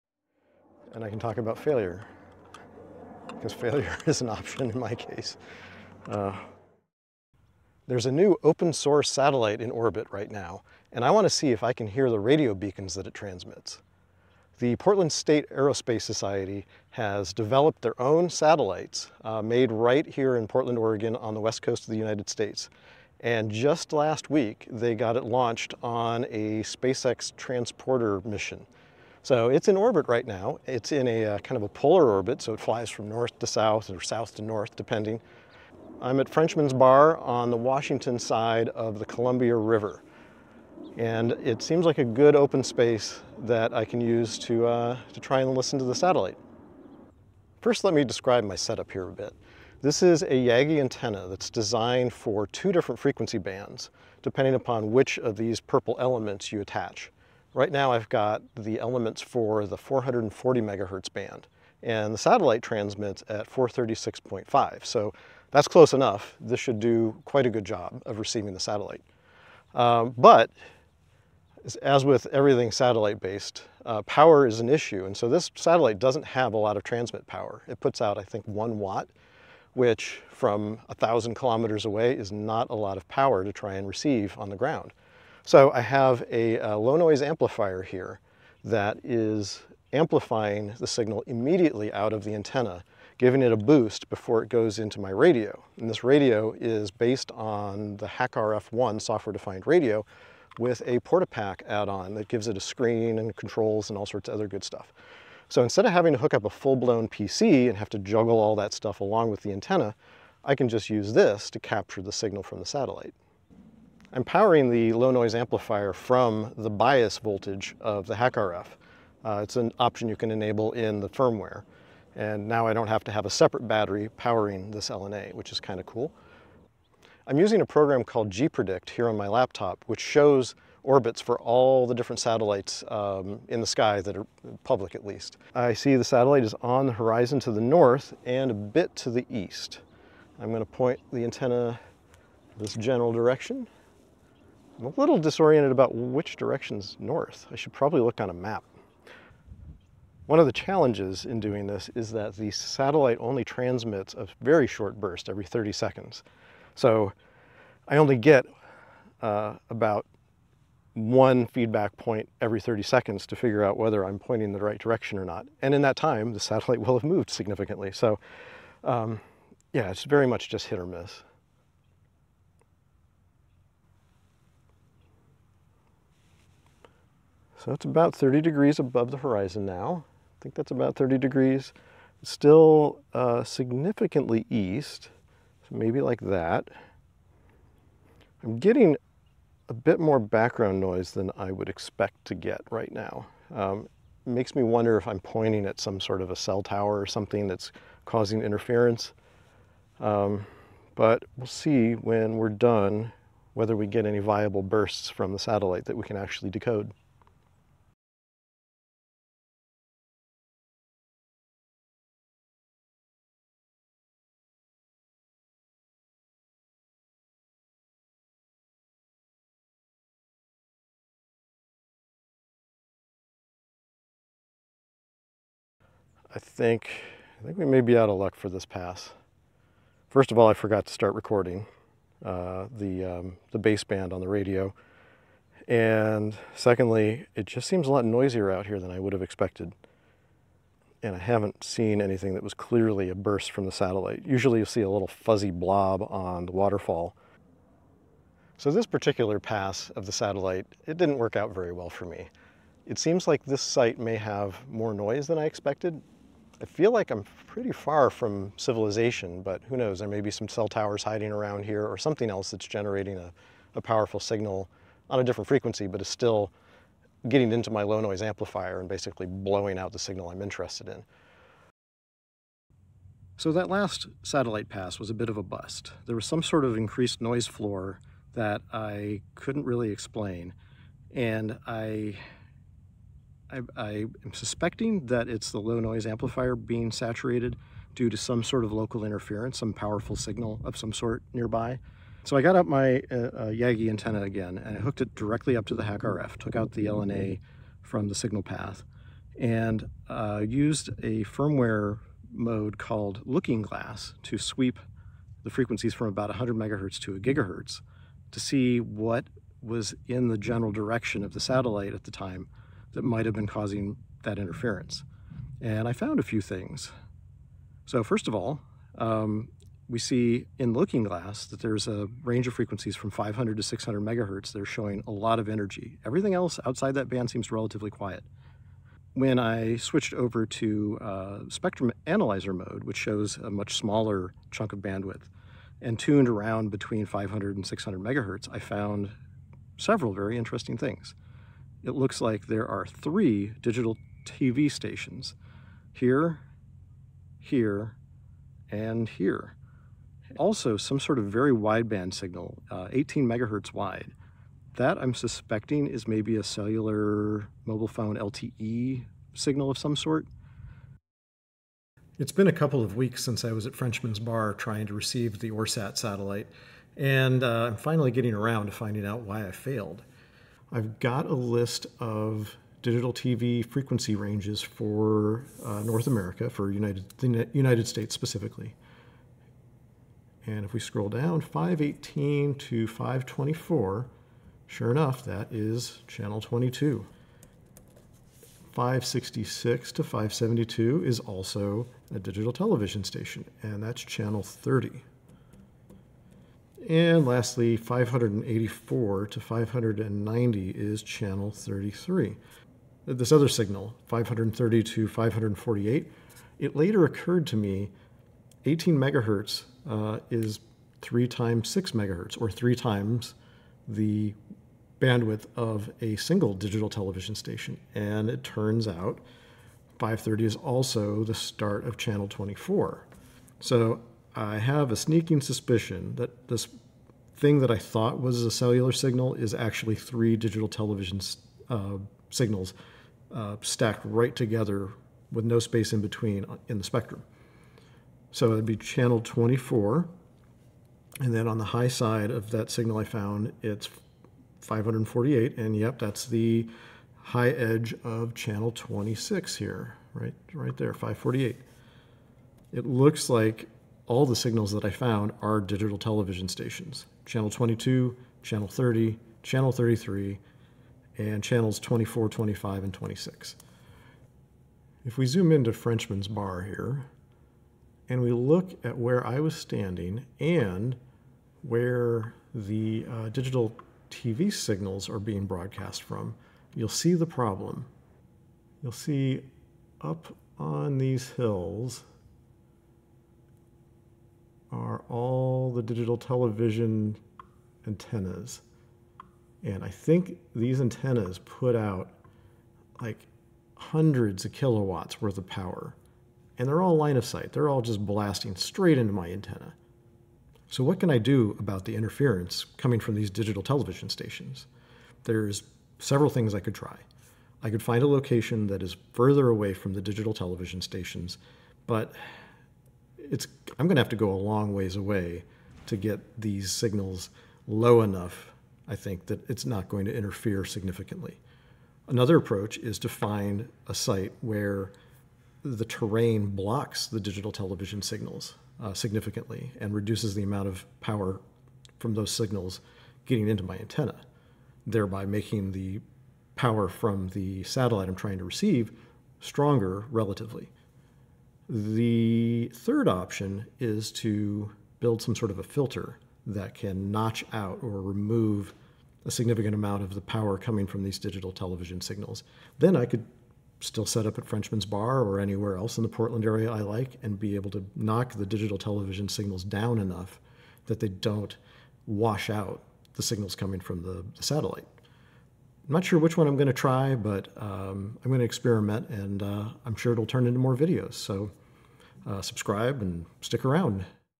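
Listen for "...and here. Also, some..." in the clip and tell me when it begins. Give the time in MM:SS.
05:48.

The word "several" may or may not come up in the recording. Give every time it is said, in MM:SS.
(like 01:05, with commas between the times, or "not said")
05:39, 08:25.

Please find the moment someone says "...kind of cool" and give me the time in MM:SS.
02:05.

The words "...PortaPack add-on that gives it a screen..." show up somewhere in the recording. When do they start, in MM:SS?
01:40.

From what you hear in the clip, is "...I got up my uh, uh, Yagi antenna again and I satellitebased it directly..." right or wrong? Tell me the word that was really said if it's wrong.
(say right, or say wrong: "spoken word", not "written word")
wrong: "hooked", not "satellitebased".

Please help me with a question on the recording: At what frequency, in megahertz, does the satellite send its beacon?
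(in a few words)
436.5.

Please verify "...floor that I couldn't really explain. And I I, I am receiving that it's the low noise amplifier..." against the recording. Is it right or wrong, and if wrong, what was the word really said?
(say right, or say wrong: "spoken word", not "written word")
wrong: "suspecting", not "receiving".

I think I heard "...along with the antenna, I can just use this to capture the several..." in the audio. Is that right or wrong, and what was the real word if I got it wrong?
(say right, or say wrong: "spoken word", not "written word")
wrong: "signal", not "several".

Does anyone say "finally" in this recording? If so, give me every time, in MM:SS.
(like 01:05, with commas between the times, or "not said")
06:07.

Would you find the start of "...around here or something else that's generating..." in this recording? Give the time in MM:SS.
04:21.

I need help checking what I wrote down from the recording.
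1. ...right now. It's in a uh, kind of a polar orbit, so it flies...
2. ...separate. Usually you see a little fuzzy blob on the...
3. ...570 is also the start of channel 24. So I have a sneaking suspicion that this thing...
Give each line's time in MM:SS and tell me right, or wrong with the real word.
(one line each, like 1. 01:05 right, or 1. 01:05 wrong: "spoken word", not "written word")
1. 00:30 right
2. 04:03 wrong: "satellite", not "separate"
3. 06:59 wrong: "530", not "570".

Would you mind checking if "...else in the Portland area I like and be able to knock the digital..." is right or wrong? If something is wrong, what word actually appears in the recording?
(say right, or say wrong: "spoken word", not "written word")
right.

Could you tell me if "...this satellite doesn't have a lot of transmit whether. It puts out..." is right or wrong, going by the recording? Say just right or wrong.
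wrong.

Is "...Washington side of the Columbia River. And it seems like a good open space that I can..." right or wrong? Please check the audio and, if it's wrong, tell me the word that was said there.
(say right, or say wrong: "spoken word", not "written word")
right.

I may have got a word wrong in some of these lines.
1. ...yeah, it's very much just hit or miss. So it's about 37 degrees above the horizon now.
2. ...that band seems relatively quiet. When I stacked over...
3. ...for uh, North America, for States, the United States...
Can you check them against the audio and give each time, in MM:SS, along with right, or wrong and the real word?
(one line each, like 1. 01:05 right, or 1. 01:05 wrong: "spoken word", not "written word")
1. 02:49 wrong: "30", not "37"
2. 05:26 wrong: "switched", not "stacked"
3. 06:14 wrong: "United", not "States".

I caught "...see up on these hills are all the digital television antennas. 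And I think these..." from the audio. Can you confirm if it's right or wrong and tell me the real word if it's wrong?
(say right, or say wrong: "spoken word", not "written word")
right.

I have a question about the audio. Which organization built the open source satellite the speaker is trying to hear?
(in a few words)
Portland State Aerospace Society.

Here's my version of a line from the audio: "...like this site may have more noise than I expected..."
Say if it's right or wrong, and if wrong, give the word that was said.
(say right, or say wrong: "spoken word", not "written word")
right.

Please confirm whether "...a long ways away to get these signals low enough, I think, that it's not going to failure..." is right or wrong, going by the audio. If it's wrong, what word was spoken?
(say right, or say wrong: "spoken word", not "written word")
wrong: "interfere", not "failure".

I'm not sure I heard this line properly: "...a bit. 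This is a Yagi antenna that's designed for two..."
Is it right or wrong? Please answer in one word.
right.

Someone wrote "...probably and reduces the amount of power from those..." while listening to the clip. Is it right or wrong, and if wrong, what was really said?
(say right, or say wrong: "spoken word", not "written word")
wrong: "significantly", not "probably".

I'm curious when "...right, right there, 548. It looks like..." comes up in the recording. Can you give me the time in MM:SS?
07:30.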